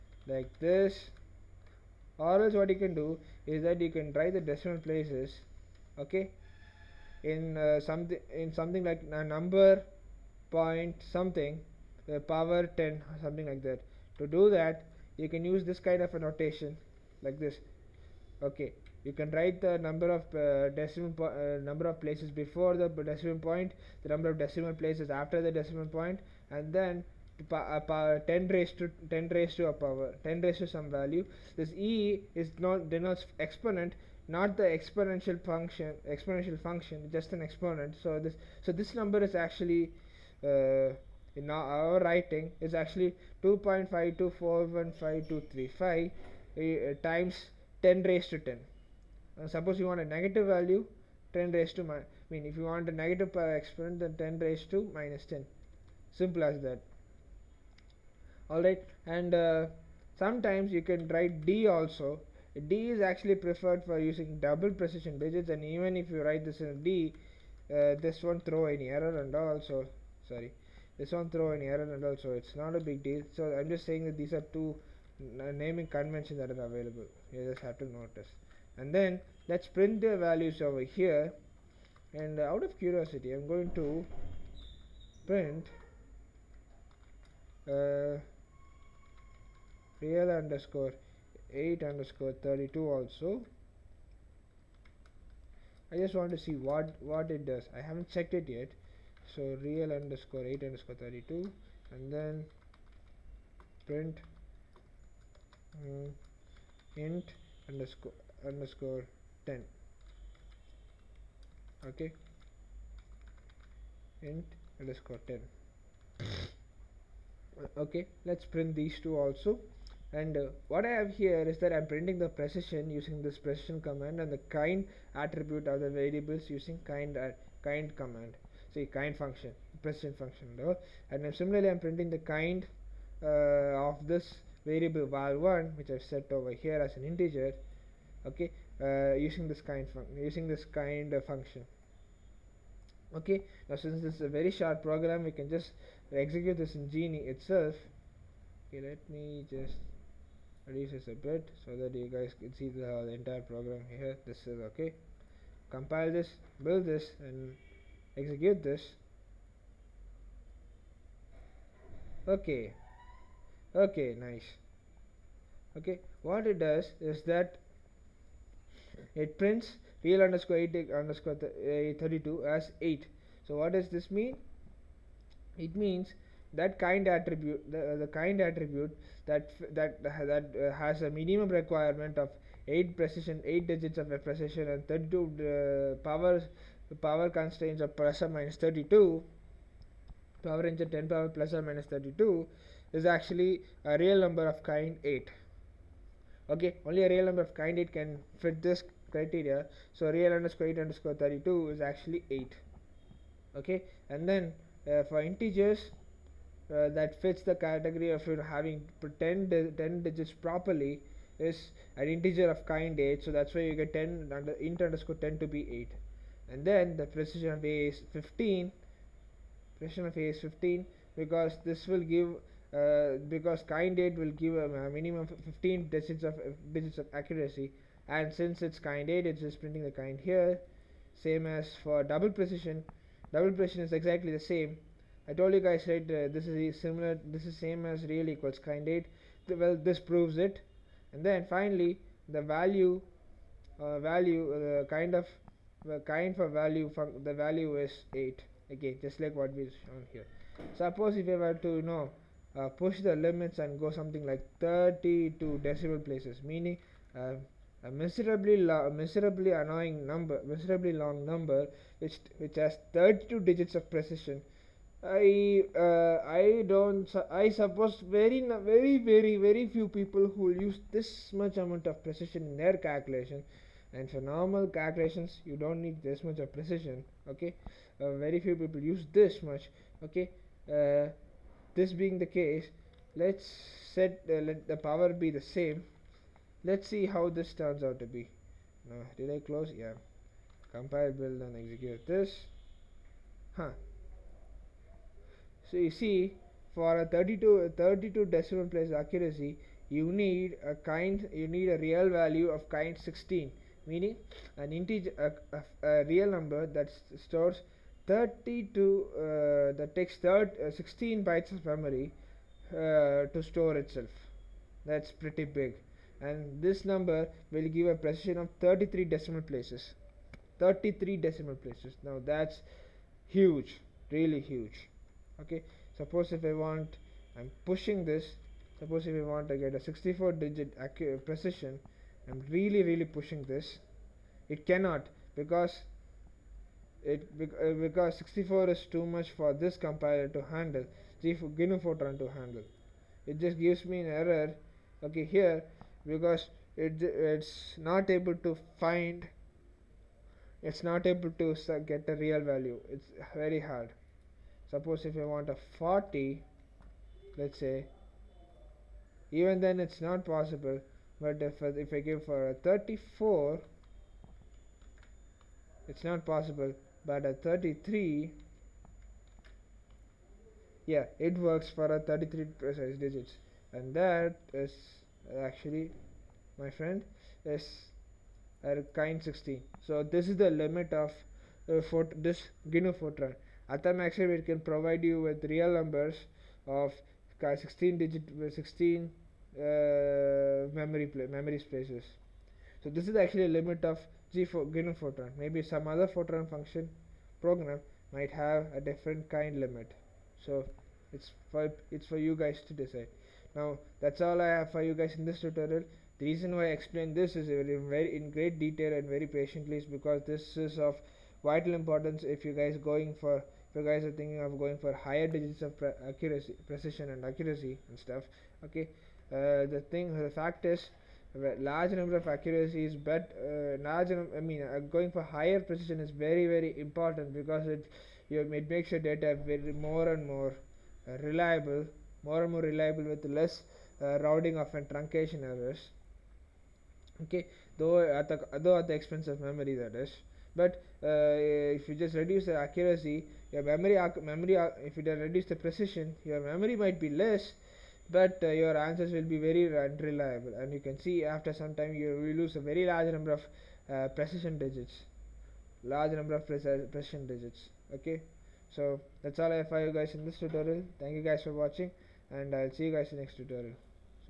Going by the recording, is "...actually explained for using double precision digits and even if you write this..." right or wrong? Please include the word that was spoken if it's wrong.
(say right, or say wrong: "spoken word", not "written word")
wrong: "preferred", not "explained".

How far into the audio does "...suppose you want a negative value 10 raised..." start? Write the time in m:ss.
0:49.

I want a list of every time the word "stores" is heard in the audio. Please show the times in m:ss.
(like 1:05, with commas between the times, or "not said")
5:07, 5:13.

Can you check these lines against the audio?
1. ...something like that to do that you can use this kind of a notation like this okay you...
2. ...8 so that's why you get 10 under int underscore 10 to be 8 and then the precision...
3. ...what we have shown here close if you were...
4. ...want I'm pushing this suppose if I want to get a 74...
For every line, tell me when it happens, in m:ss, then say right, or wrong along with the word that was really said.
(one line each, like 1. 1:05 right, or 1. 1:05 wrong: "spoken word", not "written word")
1. 0:13 right
2. 3:32 right
3. 4:09 wrong: "suppose", not "close"
4. 5:26 wrong: "64", not "74".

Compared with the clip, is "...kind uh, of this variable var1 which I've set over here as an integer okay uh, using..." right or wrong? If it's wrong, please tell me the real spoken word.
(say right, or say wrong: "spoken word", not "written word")
right.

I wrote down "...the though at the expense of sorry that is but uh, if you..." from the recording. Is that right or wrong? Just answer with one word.
wrong.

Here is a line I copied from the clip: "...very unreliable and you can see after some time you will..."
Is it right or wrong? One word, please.
right.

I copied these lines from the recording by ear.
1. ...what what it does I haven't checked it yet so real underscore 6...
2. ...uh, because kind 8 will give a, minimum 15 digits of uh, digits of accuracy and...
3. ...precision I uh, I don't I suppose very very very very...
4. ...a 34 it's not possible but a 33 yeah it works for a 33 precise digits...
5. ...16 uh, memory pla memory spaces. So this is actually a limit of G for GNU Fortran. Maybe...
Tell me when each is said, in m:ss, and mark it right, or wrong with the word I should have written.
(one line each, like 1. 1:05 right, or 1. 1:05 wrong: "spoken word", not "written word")
1. 1:36 wrong: "8", not "6"
2. 3:42 right
3. 4:23 right
4. 6:02 right
5. 6:28 right.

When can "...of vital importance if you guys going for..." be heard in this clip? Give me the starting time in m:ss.
6:50.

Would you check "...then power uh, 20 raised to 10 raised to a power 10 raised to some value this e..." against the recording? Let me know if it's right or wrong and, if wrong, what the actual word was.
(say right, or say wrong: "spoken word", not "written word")
wrong: "10", not "20".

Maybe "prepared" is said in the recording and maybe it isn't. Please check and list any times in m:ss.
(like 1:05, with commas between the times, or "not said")
not said.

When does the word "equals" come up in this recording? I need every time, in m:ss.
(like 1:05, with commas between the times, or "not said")
3:58.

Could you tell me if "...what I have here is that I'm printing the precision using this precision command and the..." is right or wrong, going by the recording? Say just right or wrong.
right.